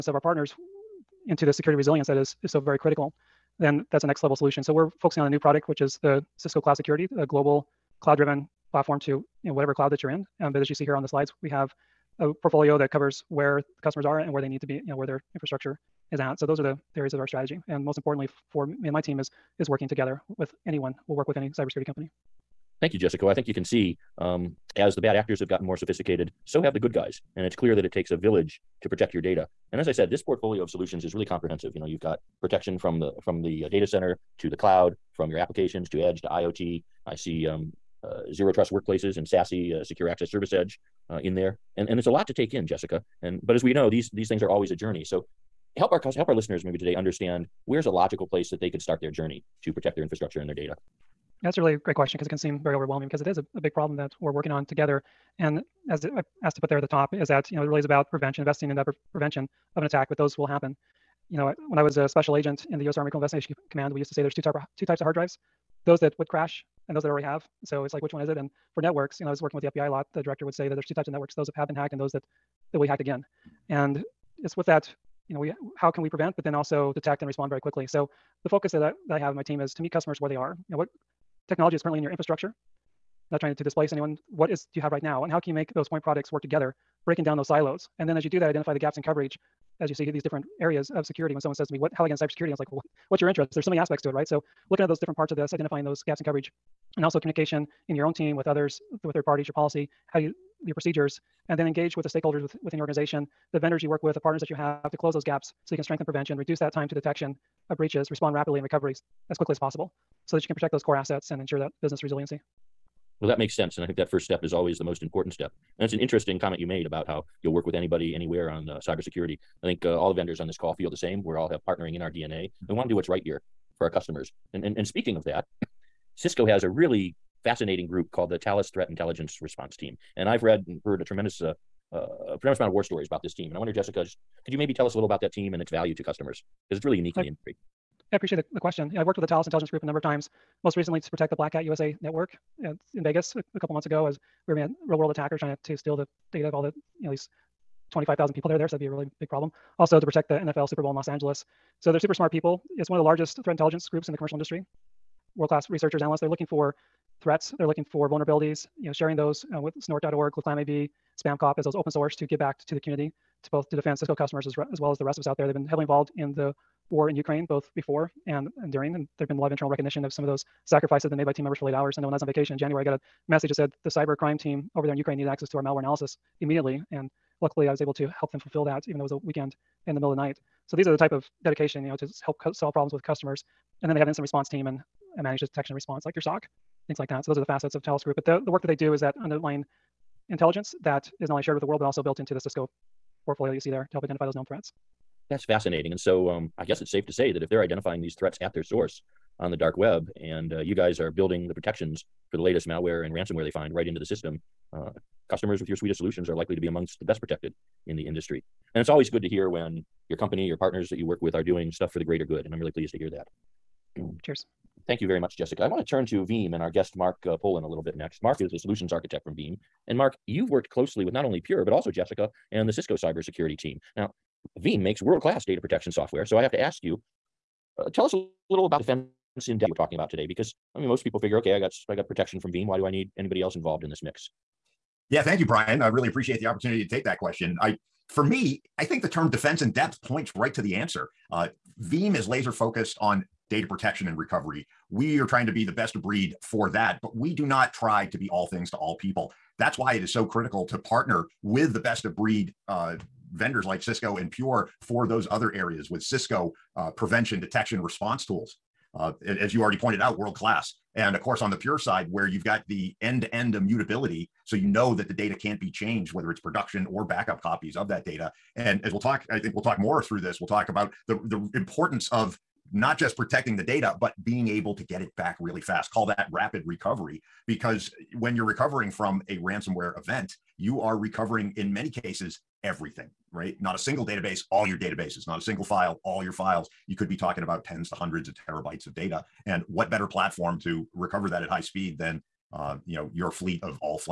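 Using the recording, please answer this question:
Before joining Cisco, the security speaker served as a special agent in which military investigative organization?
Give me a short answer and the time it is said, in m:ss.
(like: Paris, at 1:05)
U.S. Army Criminal Investigation Command, at 1:02.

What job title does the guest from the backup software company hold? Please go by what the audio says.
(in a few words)
solutions architect.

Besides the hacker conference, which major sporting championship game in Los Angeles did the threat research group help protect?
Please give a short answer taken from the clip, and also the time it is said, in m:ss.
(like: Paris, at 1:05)
NFL Super Bowl, at 2:30.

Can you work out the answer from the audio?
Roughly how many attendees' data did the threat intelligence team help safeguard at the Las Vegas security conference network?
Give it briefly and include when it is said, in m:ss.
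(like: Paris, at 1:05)
25,000, at 2:27.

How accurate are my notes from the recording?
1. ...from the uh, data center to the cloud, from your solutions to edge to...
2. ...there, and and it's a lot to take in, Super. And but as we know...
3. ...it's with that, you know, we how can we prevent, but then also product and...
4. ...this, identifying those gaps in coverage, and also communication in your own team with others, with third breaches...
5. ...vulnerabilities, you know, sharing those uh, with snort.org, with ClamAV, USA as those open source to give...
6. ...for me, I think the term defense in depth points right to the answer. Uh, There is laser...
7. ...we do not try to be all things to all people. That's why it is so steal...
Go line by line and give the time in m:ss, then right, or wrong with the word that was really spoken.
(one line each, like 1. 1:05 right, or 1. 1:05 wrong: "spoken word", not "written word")
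1. 0:33 wrong: "applications", not "solutions"
2. 0:41 wrong: "Jessica", not "Super"
3. 1:14 wrong: "detect", not "product"
4. 1:35 wrong: "parties", not "breaches"
5. 2:38 wrong: "SpamCop", not "USA"
6. 3:58 wrong: "Veeam", not "There"
7. 4:07 wrong: "critical", not "steal".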